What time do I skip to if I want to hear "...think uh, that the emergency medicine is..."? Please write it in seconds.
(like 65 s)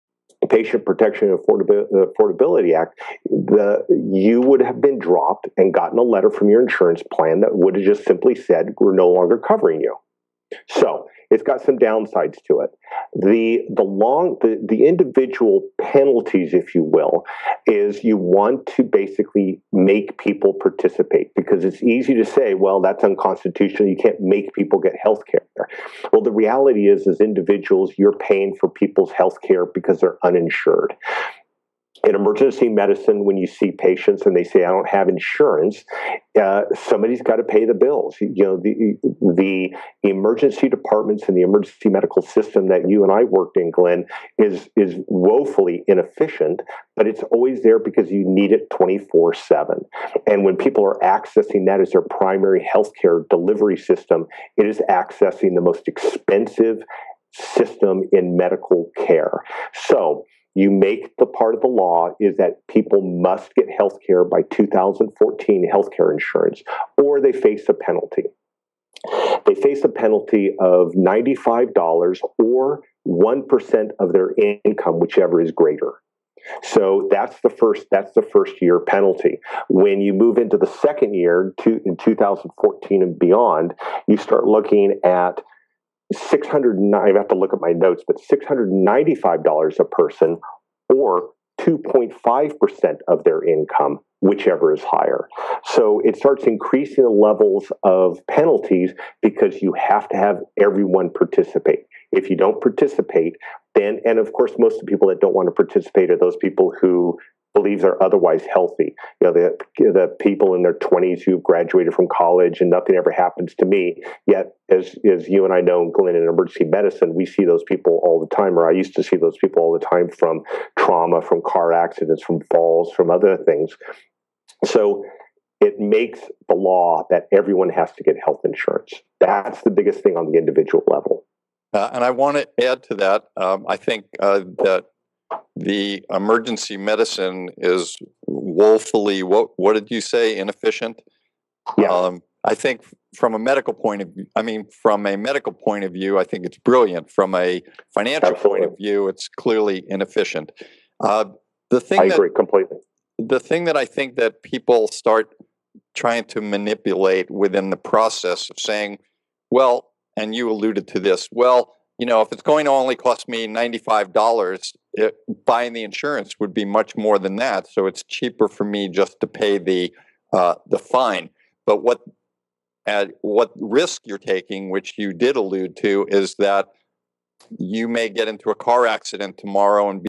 133 s.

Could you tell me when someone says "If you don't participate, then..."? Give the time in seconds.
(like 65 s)
102 s.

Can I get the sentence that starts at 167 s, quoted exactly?
So it's cheaper for me just to pay the uh, the fine.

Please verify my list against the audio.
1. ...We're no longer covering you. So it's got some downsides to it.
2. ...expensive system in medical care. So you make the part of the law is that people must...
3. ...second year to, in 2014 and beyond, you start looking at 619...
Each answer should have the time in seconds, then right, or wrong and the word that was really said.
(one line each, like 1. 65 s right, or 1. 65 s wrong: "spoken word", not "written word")
1. 8 s right
2. 55 s right
3. 80 s wrong: "609", not "619".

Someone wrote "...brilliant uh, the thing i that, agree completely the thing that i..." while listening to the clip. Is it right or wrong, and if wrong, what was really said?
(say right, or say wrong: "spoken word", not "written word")
wrong: "inefficient", not "brilliant".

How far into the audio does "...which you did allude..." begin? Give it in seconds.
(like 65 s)
174 s.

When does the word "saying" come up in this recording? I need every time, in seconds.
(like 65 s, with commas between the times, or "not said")
158 s.